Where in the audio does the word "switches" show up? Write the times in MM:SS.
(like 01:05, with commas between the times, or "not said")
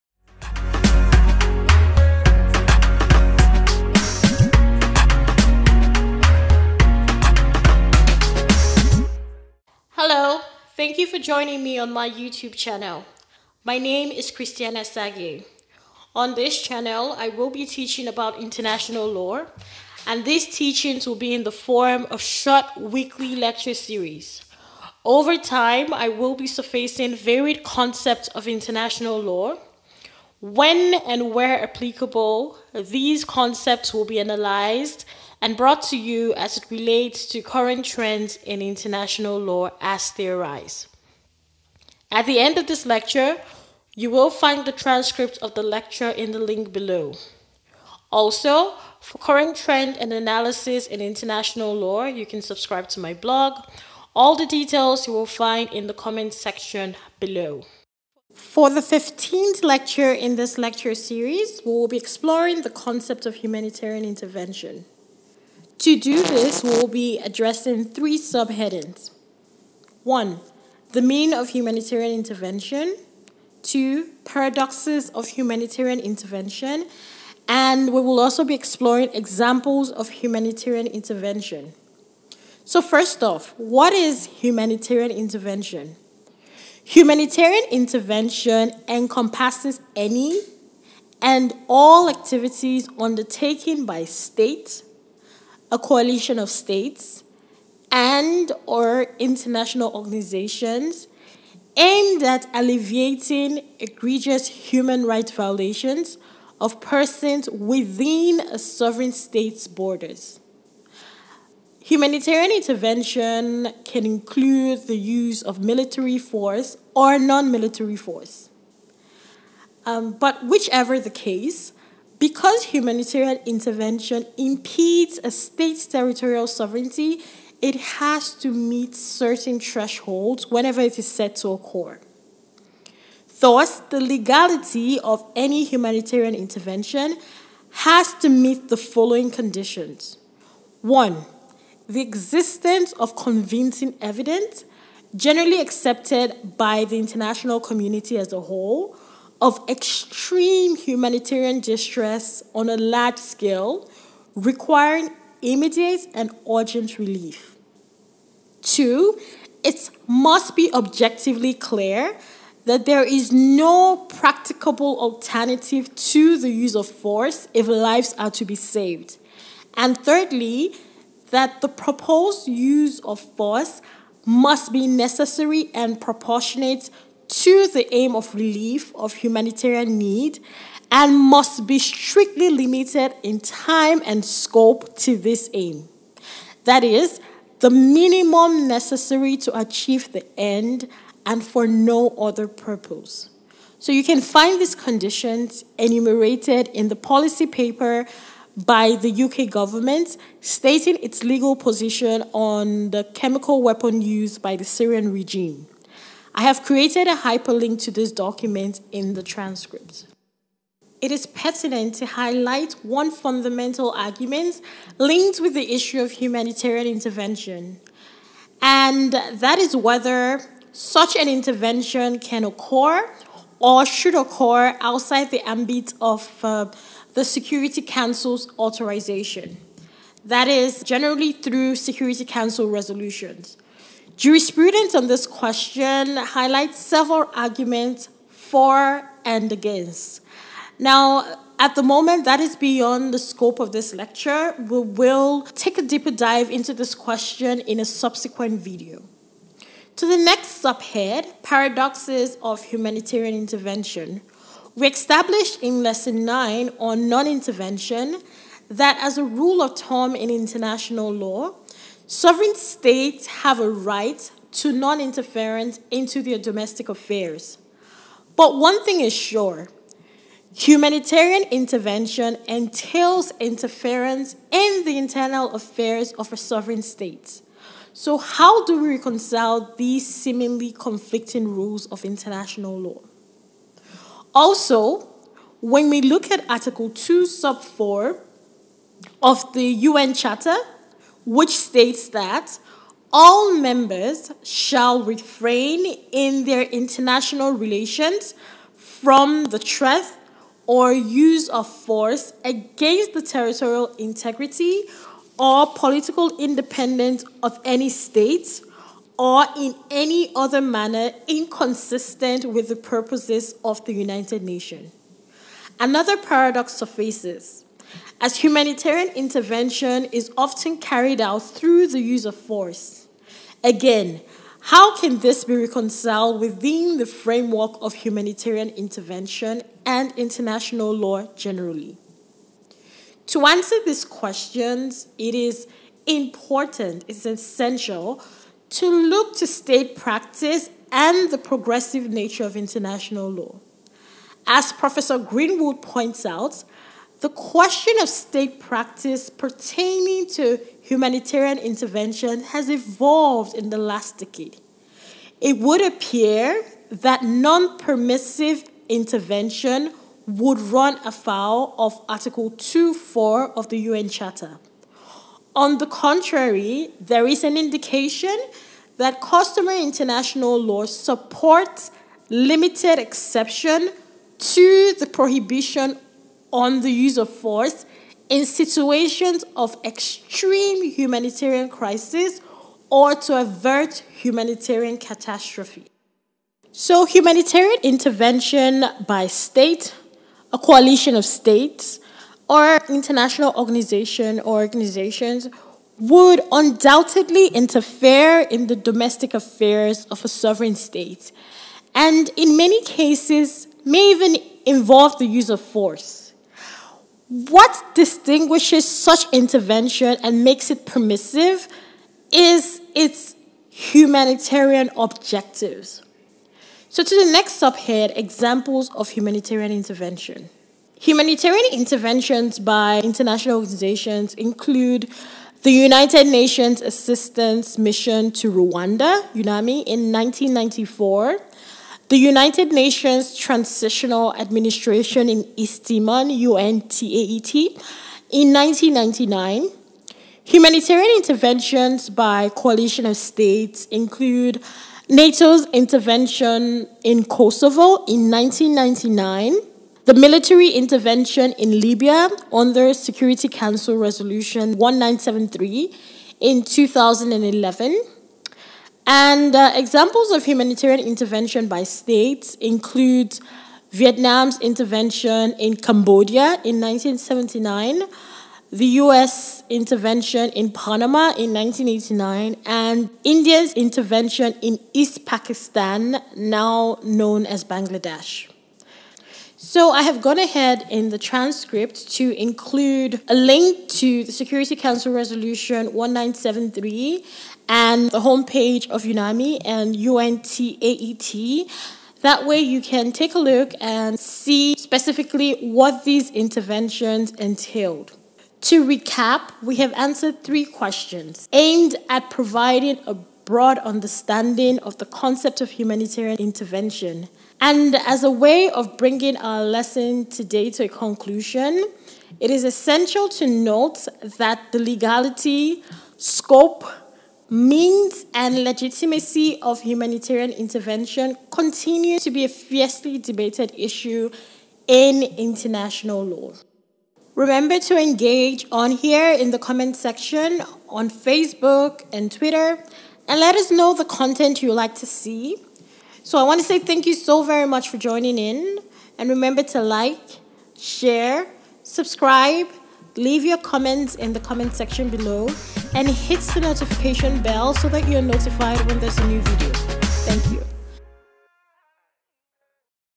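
not said.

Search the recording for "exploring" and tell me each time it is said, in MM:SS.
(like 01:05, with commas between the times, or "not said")
01:01, 01:18.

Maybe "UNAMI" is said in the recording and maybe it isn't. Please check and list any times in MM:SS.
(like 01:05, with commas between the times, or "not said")
07:09, 08:09.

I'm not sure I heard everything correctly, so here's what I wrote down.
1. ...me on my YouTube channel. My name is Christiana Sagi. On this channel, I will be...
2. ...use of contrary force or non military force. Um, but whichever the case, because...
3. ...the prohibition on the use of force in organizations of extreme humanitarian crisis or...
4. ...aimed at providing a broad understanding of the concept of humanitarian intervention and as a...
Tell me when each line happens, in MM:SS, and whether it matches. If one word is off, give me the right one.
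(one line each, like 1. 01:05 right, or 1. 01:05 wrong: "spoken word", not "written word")
1. 00:11 right
2. 01:54 wrong: "military", not "contrary"
3. 06:14 wrong: "situations", not "organizations"
4. 08:21 right.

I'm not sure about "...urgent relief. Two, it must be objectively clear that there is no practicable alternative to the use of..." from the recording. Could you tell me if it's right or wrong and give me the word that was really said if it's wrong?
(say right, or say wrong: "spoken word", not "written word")
right.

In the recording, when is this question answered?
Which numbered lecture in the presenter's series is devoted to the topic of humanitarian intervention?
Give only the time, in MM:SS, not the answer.
00:58.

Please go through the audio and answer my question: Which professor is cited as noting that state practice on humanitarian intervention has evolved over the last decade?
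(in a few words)
Professor Greenwood.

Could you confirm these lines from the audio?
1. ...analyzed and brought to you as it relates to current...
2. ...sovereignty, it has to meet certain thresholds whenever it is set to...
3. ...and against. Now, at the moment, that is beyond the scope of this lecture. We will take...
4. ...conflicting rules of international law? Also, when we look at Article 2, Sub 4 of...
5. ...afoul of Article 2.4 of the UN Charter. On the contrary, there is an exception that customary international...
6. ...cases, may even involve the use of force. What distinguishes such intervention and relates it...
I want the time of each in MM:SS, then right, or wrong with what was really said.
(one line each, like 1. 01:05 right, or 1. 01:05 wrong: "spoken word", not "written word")
1. 00:34 right
2. 02:06 right
3. 03:59 right
4. 04:40 right
5. 06:01 wrong: "indication", not "exception"
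6. 06:42 wrong: "makes", not "relates".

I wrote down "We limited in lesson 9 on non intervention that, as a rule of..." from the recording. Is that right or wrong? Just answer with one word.
wrong.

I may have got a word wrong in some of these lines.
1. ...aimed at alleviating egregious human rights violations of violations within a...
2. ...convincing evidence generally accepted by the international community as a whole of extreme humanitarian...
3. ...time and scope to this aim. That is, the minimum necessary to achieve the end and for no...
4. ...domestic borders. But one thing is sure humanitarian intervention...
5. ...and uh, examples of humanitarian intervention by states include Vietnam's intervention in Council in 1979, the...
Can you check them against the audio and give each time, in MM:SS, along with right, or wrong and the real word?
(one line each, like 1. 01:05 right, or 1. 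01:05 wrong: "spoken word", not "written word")
1. 01:41 wrong: "persons", not "violations"
2. 02:23 right
3. 03:03 right
4. 04:26 wrong: "affairs", not "borders"
5. 07:39 wrong: "Cambodia", not "Council".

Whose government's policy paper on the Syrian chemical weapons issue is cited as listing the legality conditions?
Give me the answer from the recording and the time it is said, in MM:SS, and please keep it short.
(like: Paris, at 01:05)
UK, at 03:19.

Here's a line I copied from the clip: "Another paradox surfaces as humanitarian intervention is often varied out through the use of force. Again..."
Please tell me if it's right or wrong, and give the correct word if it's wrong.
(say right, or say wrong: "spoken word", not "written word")
wrong: "carried", not "varied".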